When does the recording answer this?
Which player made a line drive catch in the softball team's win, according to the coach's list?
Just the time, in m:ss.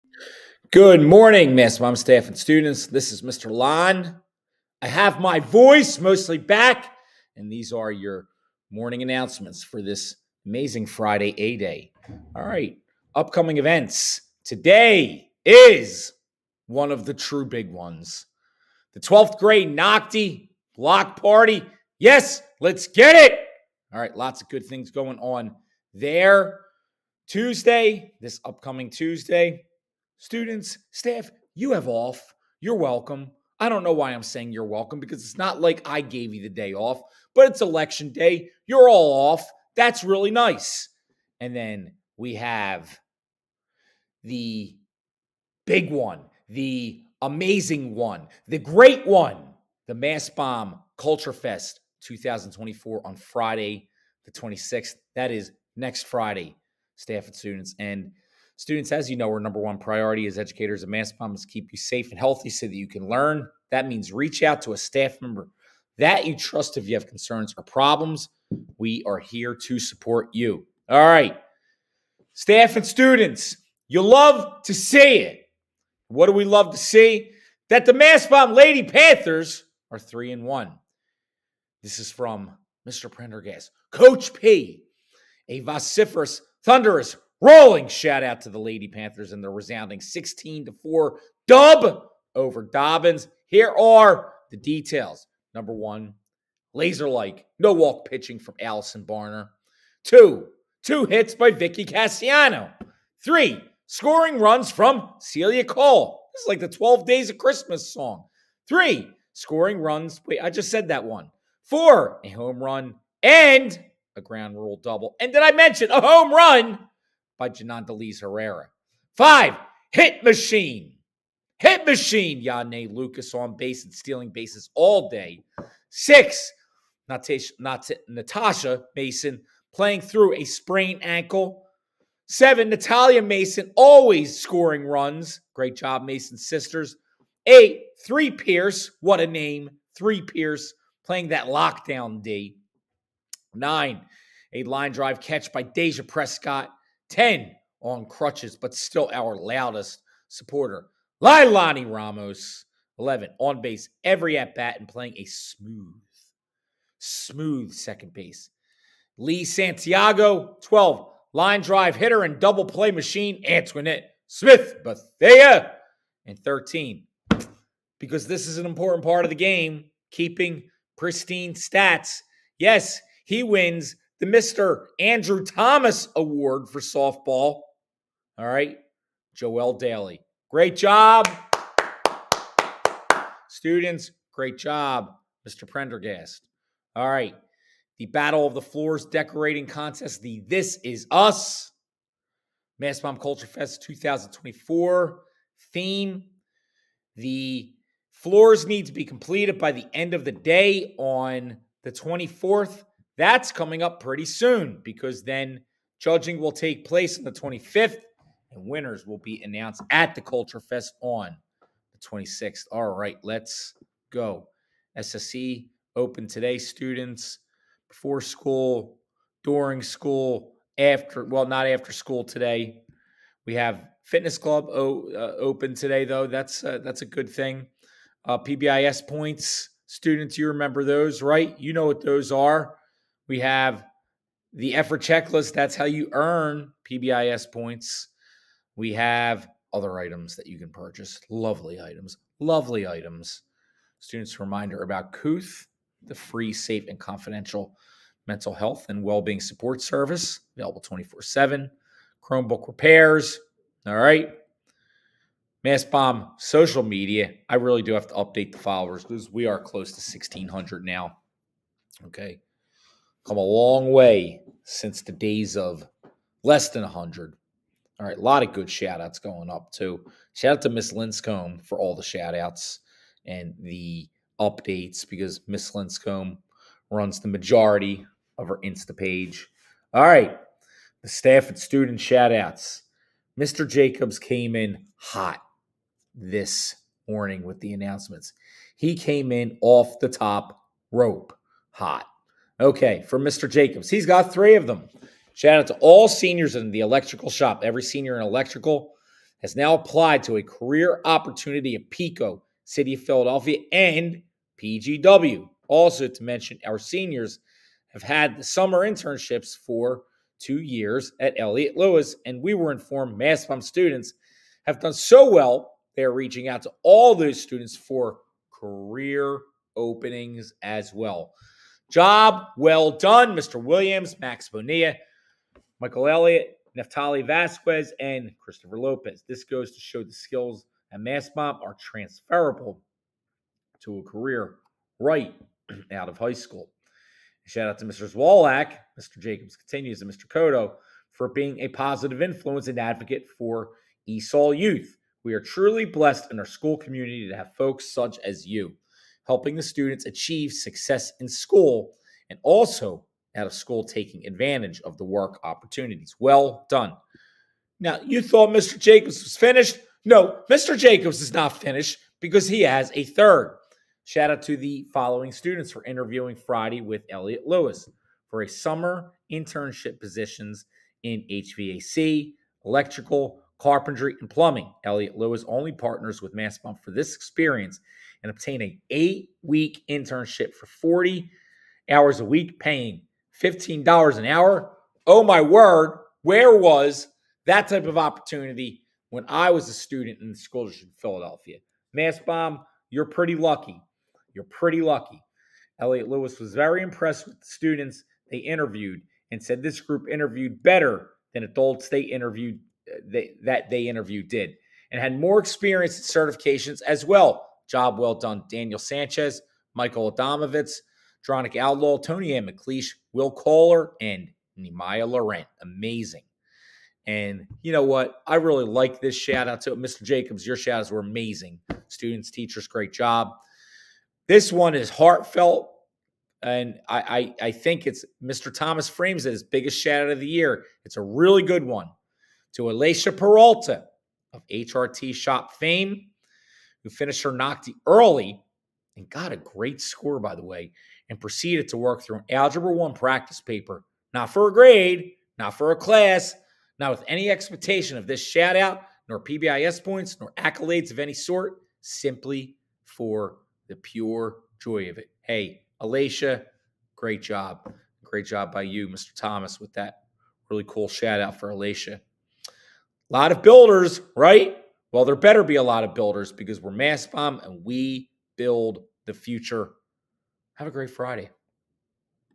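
2:25.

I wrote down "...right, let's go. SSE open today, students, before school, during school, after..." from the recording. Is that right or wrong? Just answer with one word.
right.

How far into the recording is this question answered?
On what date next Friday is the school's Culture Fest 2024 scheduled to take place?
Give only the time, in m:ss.
0:53.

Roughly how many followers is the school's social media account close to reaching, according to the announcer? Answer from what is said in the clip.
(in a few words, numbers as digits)
1600.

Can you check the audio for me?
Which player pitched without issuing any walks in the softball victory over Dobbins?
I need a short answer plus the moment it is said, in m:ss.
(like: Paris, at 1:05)
Allison Barner, at 1:38.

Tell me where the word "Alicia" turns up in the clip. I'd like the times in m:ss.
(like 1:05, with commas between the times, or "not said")
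7:12, 7:35, 7:41.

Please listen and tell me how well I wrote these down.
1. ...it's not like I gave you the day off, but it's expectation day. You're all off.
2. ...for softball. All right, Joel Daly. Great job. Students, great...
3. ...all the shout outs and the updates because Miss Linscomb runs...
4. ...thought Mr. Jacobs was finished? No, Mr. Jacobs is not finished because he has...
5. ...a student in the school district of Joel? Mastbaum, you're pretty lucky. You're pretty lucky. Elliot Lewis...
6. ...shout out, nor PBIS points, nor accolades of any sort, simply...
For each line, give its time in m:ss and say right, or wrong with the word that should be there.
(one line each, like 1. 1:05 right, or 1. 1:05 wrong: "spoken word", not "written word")
1. 0:35 wrong: "election", not "expectation"
2. 2:56 right
3. 4:31 right
4. 5:58 right
5. 6:29 wrong: "Philadelphia", not "Joel"
6. 7:28 right.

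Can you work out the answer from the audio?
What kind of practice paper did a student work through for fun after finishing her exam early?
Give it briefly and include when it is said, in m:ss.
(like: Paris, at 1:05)
Algebra 1, at 7:22.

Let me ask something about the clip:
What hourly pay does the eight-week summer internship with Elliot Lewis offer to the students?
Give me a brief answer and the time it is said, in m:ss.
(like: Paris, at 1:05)
$15 an hour, at 6:23.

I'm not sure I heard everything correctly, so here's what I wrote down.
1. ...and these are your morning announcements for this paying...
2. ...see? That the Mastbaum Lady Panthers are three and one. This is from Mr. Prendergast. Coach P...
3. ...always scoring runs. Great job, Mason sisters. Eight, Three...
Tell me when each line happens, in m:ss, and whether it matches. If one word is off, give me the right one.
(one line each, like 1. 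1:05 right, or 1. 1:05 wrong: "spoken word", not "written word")
1. 0:07 wrong: "amazing", not "paying"
2. 1:16 right
3. 2:13 right.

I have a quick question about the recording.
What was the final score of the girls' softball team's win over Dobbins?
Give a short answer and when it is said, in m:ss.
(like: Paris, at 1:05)
16 to 4, at 1:29.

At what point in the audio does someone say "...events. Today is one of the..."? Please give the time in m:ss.
0:13.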